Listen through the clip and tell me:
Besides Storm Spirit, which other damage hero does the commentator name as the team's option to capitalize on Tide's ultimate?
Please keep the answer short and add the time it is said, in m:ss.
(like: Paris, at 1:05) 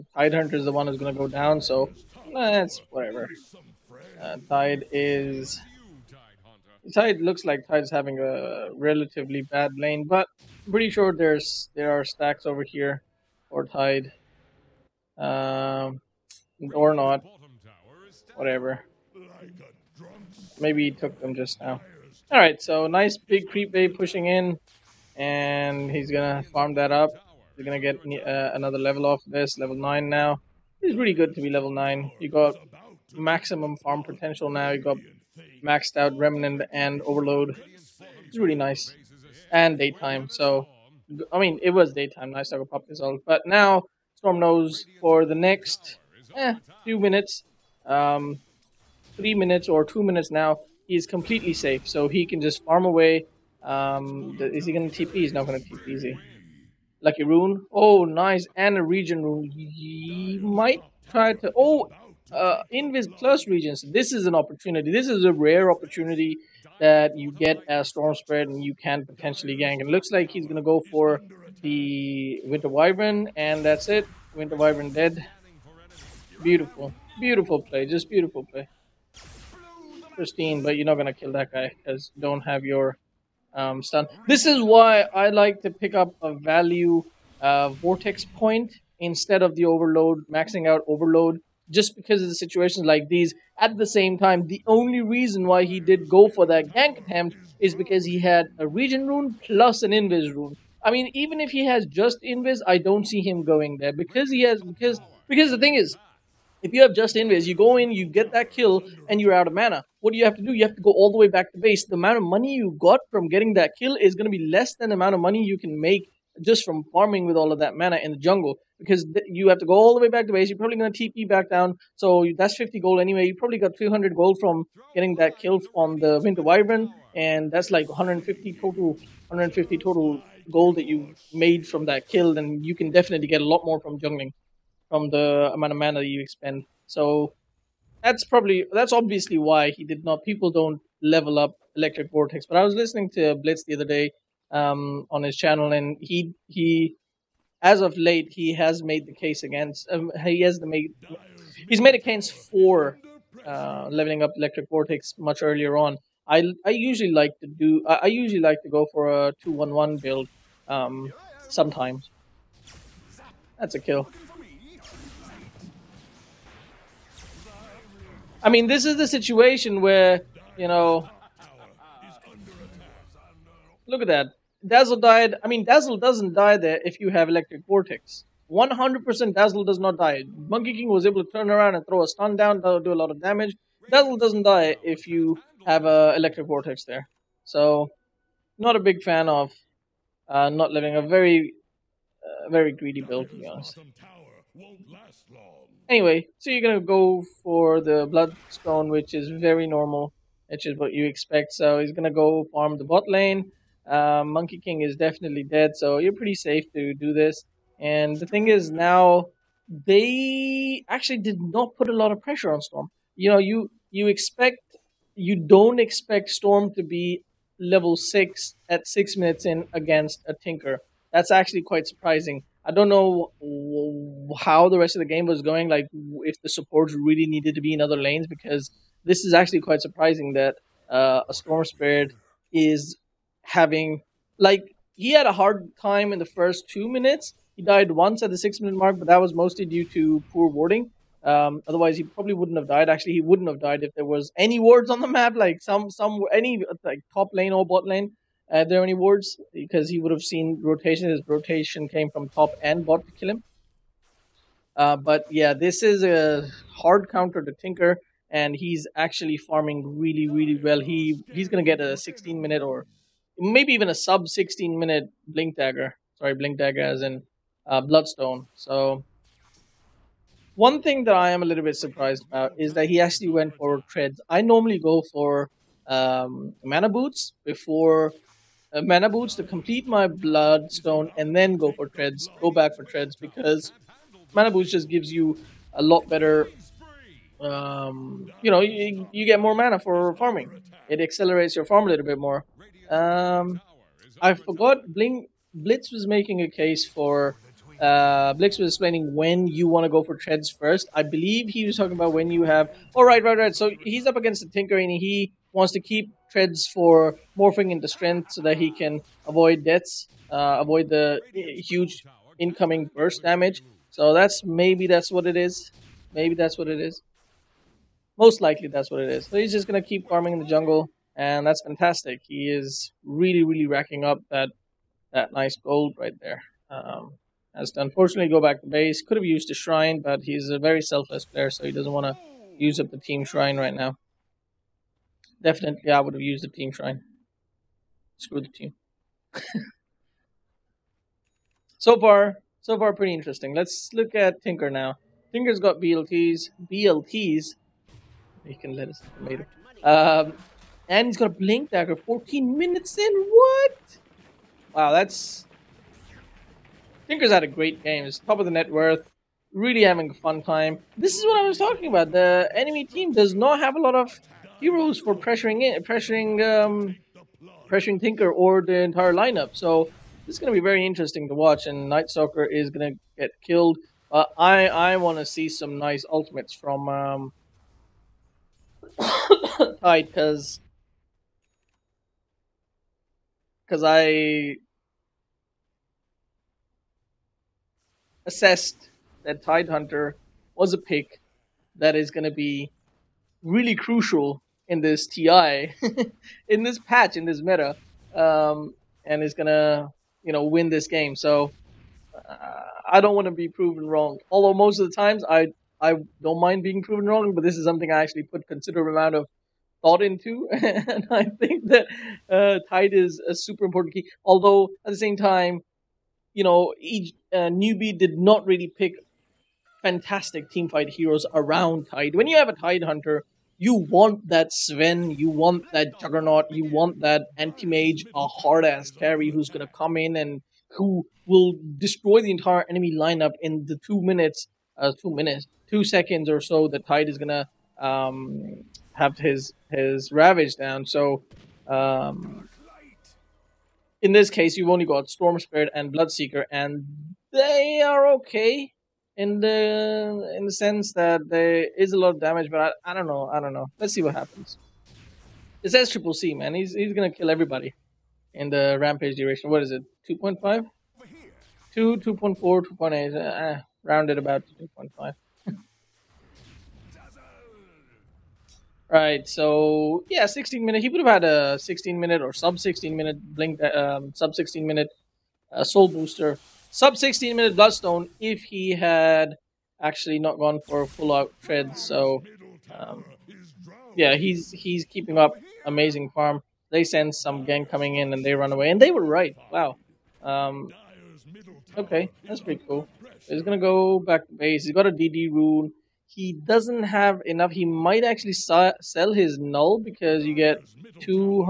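Bloodseeker, at 7:25.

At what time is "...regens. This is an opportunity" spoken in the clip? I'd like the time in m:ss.
1:03.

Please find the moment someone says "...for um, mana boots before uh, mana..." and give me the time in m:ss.
4:35.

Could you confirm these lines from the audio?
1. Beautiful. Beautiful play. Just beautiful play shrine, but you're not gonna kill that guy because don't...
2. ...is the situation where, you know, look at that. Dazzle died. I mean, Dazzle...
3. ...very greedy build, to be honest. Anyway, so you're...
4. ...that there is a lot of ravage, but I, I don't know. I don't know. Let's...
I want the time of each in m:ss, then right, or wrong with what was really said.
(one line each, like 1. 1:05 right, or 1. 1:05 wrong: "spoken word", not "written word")
1. 1:16 wrong: "pristine", not "shrine"
2. 2:48 right
3. 3:12 right
4. 7:30 wrong: "damage", not "ravage".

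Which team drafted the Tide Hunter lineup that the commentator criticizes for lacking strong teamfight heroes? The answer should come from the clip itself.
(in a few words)
Newbee.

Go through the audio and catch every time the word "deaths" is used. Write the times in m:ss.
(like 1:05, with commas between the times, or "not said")
5:09.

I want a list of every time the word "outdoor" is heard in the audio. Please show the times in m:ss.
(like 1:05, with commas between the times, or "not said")
not said.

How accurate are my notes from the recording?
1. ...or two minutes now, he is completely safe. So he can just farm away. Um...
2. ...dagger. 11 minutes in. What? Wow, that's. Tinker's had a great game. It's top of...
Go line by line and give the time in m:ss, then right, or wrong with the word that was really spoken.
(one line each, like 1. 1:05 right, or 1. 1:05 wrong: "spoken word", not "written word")
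1. 0:49 right
2. 5:51 wrong: "14", not "11".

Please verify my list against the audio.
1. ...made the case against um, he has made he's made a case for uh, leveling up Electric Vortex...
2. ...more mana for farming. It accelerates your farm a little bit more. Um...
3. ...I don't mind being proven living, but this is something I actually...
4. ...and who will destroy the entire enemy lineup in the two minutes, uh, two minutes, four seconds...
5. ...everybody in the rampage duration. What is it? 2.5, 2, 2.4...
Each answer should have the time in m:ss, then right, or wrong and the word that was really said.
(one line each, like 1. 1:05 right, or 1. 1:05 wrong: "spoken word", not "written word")
1. 2:28 right
2. 4:49 right
3. 6:45 wrong: "wrong", not "living"
4. 7:10 wrong: "two", not "four"
5. 7:37 right.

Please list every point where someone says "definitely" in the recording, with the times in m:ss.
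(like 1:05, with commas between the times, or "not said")
2:12, 3:24, 5:35.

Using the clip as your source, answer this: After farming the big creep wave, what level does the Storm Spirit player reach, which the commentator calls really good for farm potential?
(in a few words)
9.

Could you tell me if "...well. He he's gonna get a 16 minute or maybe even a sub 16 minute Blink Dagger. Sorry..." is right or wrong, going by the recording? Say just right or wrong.
right.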